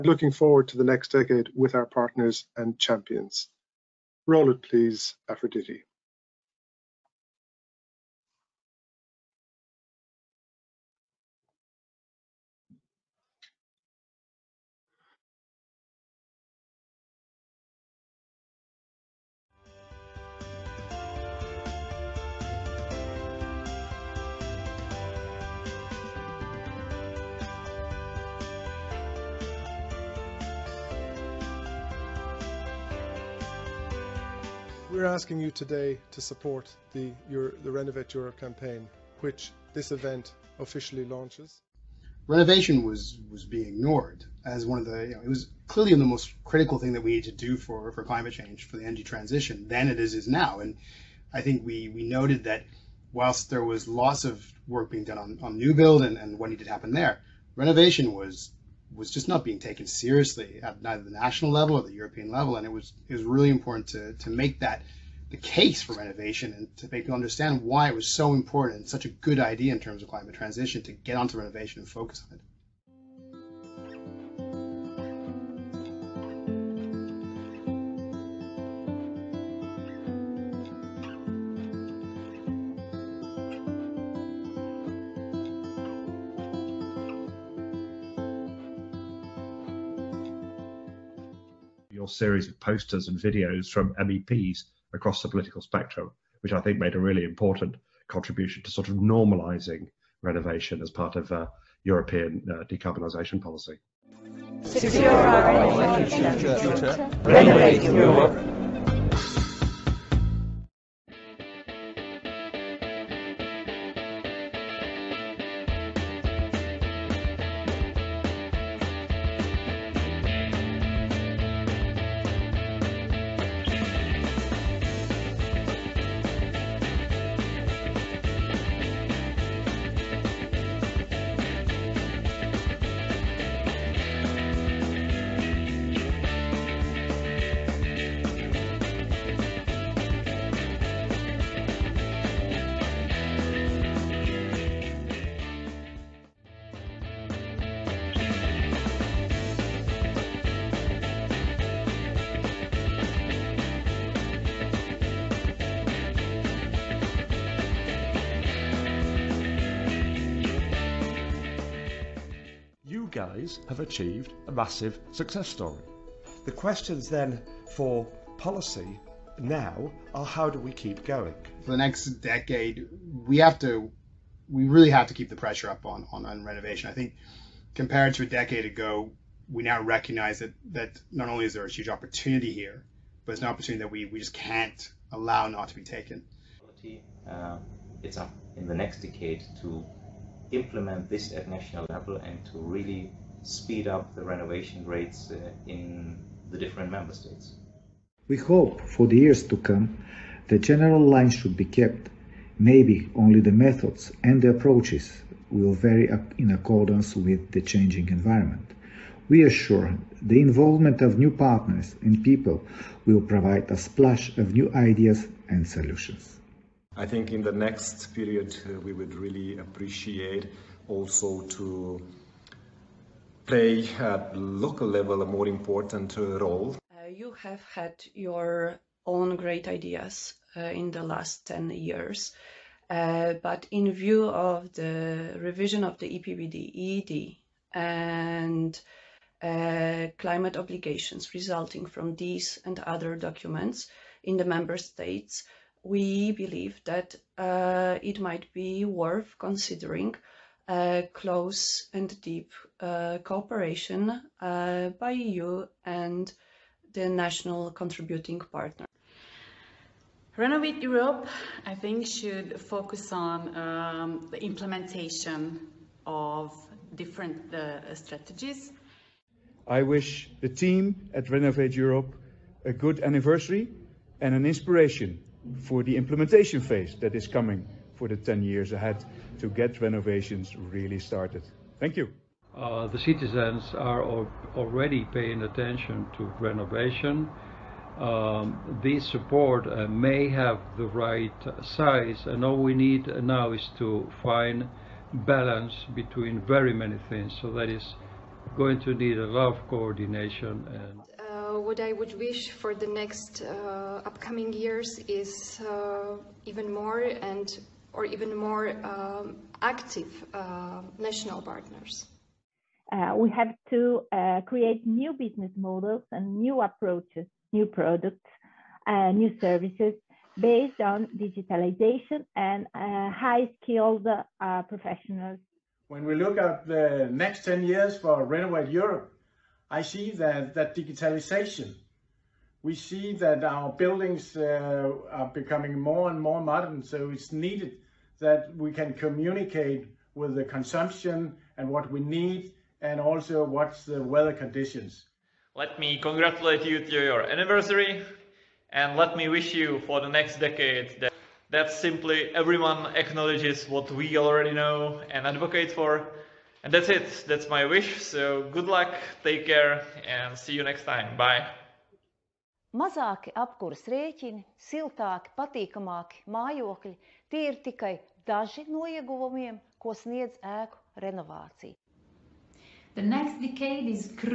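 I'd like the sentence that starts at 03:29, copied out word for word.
We are sure the involvement of new partners and people will provide a splash of new ideas and solutions.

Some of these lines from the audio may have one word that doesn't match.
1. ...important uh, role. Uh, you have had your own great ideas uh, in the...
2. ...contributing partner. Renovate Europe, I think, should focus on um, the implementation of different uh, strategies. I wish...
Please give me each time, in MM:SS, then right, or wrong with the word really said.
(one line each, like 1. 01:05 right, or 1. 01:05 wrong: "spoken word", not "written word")
1. 03:45 right
2. 04:17 right.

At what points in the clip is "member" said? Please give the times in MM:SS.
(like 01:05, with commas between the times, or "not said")
03:16, 04:04.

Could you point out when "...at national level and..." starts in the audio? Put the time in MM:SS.
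03:11.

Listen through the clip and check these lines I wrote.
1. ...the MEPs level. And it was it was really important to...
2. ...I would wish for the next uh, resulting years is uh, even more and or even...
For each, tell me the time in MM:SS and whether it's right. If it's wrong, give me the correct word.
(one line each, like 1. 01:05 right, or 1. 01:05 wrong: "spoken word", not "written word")
1. 01:01 wrong: "European", not "MEPs"
2. 05:01 wrong: "upcoming", not "resulting".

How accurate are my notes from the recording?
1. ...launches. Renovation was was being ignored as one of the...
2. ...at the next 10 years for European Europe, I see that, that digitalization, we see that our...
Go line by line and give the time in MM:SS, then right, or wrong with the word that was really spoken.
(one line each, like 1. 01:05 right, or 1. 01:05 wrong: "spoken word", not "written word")
1. 00:41 right
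2. 05:26 wrong: "Renovate", not "European".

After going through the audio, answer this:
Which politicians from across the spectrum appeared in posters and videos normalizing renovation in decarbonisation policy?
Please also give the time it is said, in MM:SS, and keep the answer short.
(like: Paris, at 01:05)
MEPs, at 01:33.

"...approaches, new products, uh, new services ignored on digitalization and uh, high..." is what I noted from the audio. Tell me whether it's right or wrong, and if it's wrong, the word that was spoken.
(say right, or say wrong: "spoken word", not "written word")
wrong: "based", not "ignored".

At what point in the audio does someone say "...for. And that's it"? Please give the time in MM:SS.
05:55.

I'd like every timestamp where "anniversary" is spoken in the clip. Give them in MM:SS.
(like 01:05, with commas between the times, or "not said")
04:33, 05:47.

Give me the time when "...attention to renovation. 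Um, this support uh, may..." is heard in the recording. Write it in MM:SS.
04:45.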